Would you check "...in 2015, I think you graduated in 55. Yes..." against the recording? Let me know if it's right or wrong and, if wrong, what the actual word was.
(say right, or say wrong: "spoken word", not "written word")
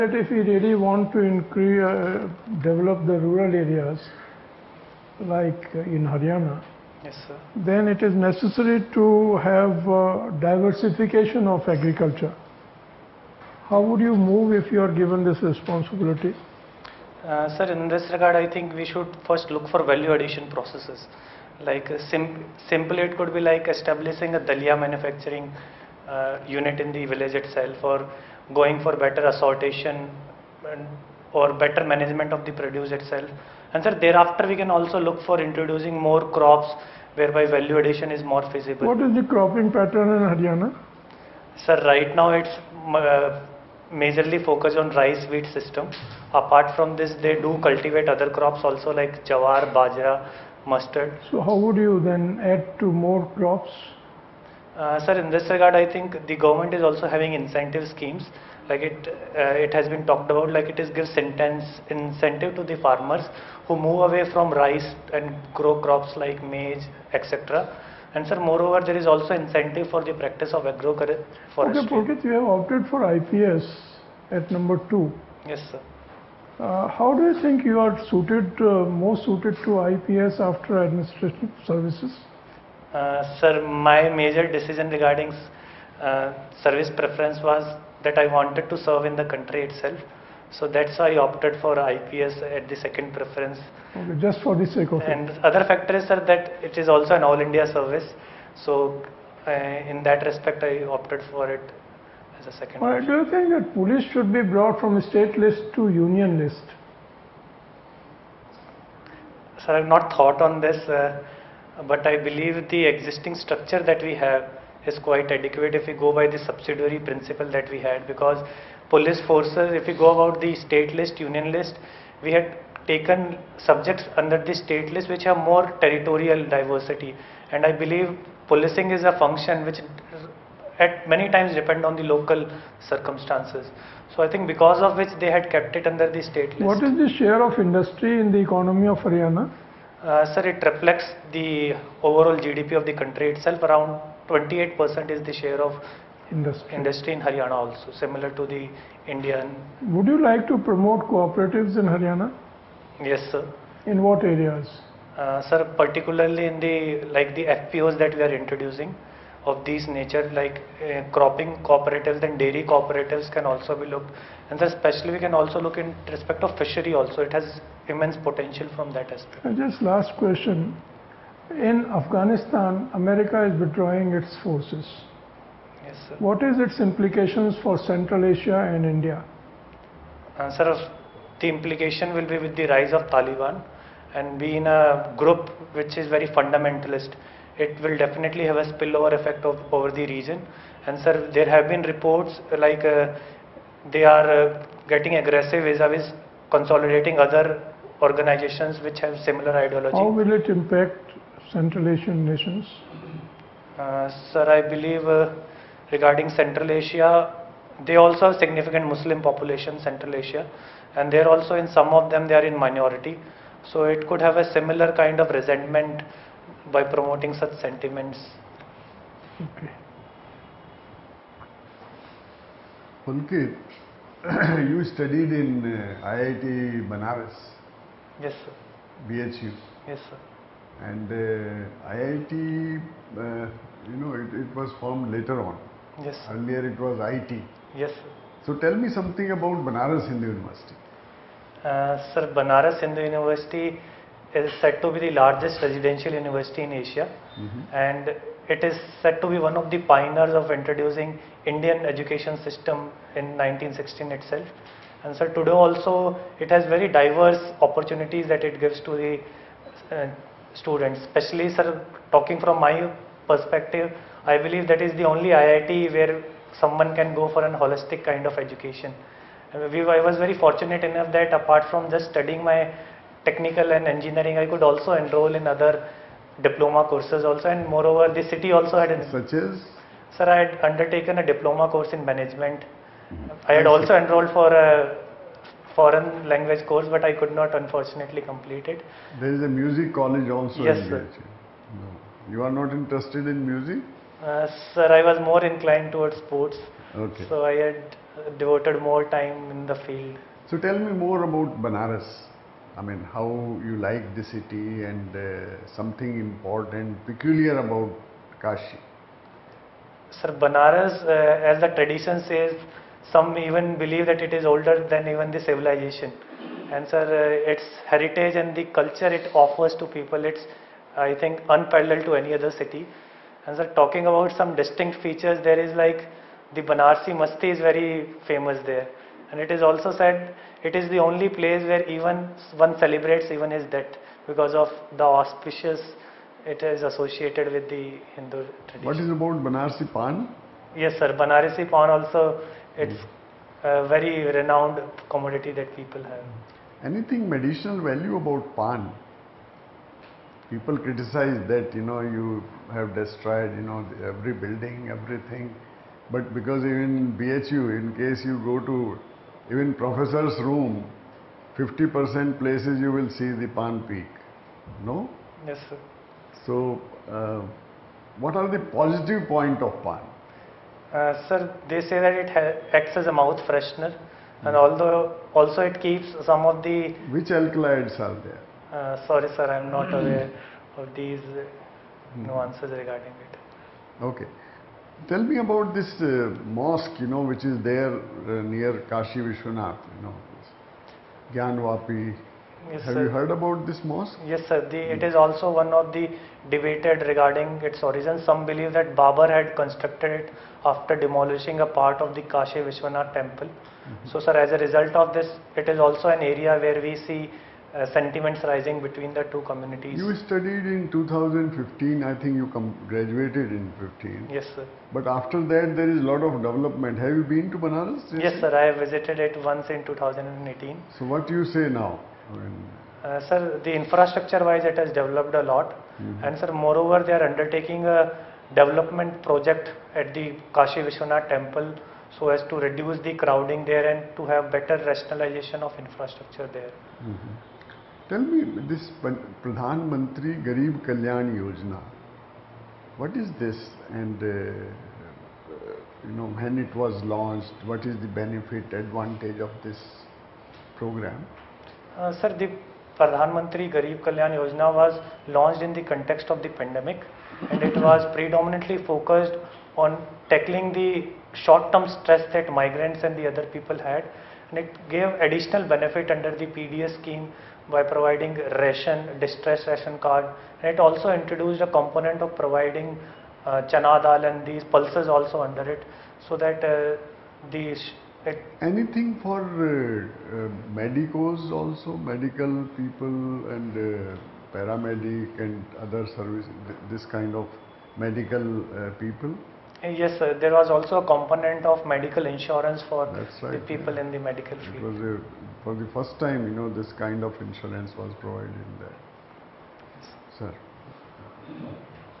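wrong: "15", not "55".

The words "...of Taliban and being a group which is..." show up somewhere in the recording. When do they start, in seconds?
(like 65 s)
182 s.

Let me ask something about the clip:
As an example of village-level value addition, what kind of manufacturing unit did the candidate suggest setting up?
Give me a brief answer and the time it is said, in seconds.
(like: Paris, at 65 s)
Dalia manufacturing unit, at 24 s.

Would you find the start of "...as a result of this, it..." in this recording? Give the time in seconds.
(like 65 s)
404 s.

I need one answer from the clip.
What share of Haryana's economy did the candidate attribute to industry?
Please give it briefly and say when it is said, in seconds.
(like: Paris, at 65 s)
28%, at 143 s.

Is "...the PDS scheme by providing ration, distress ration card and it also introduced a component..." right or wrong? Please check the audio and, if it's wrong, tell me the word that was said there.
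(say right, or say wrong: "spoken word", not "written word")
right.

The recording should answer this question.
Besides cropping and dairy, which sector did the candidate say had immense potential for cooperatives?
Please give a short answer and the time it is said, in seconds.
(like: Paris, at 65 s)
Fishery, at 166 s.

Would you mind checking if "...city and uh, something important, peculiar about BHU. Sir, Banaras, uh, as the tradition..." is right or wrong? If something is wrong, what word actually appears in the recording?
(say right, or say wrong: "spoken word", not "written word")
wrong: "Kashi", not "BHU".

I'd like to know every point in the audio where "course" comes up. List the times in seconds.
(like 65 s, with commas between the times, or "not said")
276 s, 281 s, 286 s.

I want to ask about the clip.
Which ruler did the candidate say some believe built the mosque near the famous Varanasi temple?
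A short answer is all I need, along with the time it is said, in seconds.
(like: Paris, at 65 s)
Babar, at 398 s.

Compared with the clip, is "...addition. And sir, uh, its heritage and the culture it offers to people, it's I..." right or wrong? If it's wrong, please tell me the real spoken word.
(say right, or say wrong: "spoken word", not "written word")
wrong: "civilization", not "addition".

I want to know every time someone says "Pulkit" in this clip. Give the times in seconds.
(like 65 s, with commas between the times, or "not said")
71 s, 223 s.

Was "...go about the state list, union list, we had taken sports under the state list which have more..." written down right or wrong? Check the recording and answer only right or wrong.
wrong.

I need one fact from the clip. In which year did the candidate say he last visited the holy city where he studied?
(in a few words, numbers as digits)
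2018.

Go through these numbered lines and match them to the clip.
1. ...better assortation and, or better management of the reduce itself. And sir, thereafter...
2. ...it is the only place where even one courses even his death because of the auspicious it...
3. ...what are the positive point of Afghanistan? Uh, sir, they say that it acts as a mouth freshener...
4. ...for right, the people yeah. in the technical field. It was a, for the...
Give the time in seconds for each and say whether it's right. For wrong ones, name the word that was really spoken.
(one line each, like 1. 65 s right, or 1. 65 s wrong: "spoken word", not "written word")
1. 28 s wrong: "produce", not "reduce"
2. 330 s wrong: "celebrates", not "courses"
3. 368 s wrong: "Pan", not "Afghanistan"
4. 492 s wrong: "medical", not "technical".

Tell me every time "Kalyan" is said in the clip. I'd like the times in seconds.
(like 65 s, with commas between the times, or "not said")
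440 s, 454 s.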